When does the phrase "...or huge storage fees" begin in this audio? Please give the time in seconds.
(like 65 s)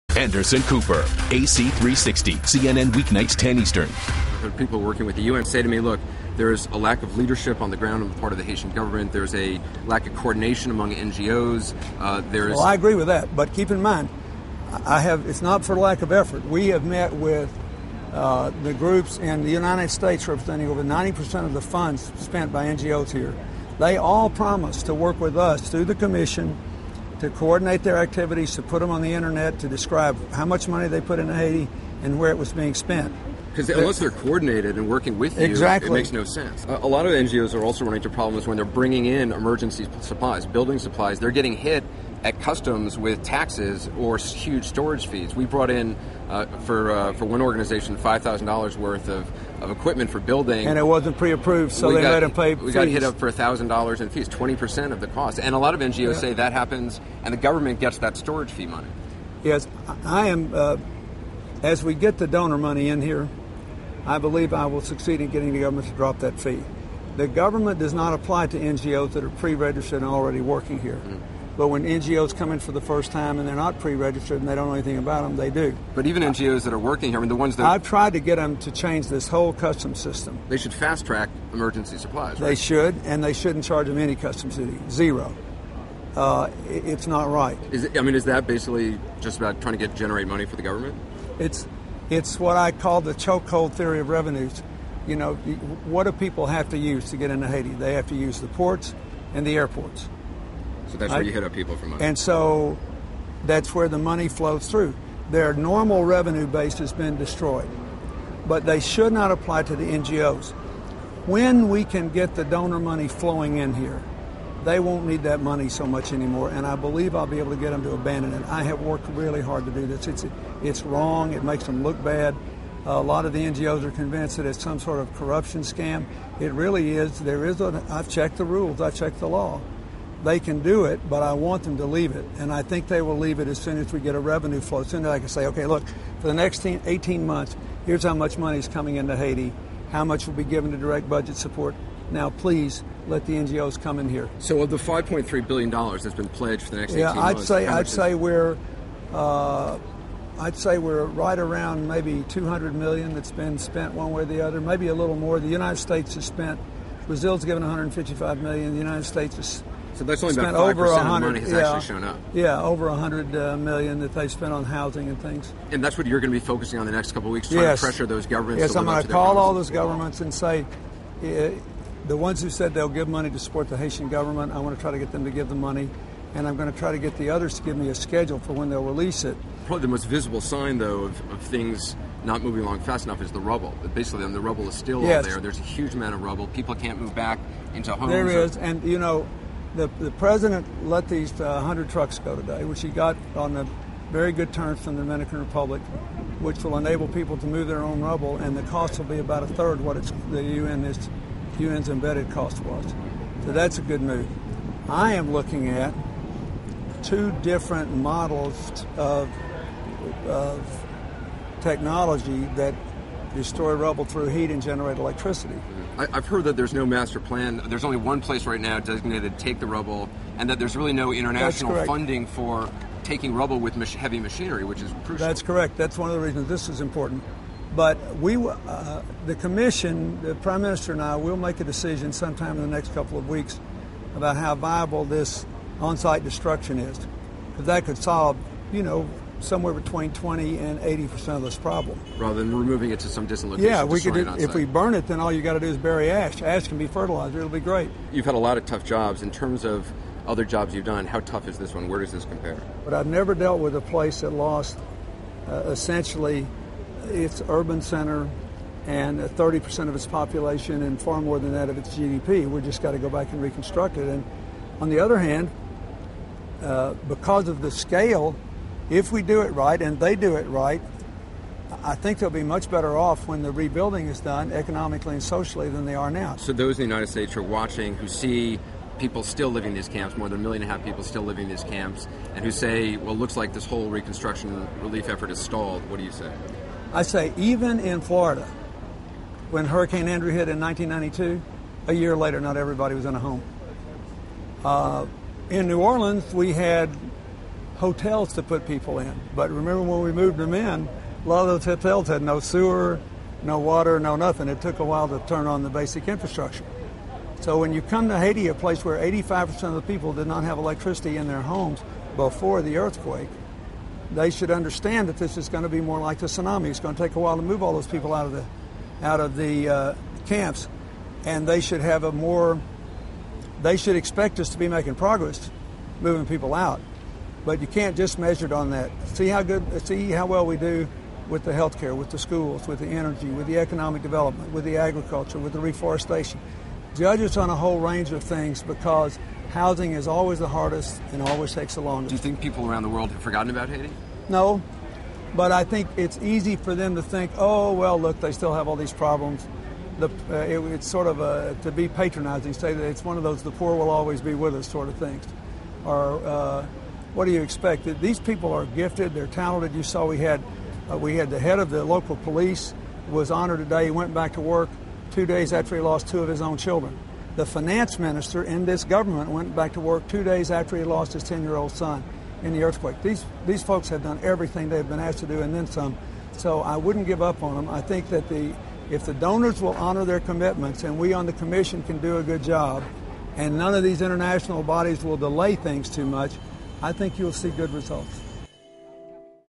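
43 s.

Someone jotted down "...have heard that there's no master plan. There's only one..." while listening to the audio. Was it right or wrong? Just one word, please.
right.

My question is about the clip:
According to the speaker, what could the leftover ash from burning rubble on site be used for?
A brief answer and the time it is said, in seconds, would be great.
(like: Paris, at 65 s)
fertilizer, at 246 s.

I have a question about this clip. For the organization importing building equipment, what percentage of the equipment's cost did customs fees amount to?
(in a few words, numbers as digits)
20%.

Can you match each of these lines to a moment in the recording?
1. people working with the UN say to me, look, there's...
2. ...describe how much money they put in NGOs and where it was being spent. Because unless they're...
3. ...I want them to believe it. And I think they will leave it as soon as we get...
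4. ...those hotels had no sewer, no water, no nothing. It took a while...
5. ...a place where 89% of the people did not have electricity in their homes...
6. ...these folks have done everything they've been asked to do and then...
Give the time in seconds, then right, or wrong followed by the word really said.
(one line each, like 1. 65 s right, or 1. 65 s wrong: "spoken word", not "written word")
1. 4 s right
2. 29 s wrong: "Haiti", not "NGOs"
3. 131 s wrong: "leave", not "believe"
4. 301 s right
5. 308 s wrong: "85", not "89"
6. 373 s right.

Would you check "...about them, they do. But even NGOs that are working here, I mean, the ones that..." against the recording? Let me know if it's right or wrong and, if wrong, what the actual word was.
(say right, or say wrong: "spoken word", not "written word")
right.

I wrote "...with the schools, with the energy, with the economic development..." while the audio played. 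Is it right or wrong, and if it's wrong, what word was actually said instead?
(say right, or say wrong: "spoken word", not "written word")
right.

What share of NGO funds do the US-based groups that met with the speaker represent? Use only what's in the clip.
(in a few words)
over 90%.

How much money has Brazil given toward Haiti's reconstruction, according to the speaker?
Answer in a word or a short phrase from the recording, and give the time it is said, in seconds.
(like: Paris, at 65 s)
155 million, at 157 s.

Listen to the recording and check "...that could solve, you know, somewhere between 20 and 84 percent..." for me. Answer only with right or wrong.
wrong.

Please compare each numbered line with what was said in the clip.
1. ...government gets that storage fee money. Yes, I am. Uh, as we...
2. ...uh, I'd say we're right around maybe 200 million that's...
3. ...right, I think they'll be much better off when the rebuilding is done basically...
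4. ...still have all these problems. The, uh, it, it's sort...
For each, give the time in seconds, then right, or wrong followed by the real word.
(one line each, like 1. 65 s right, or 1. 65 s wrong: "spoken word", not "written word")
1. 57 s right
2. 149 s right
3. 270 s wrong: "economically", not "basically"
4. 348 s right.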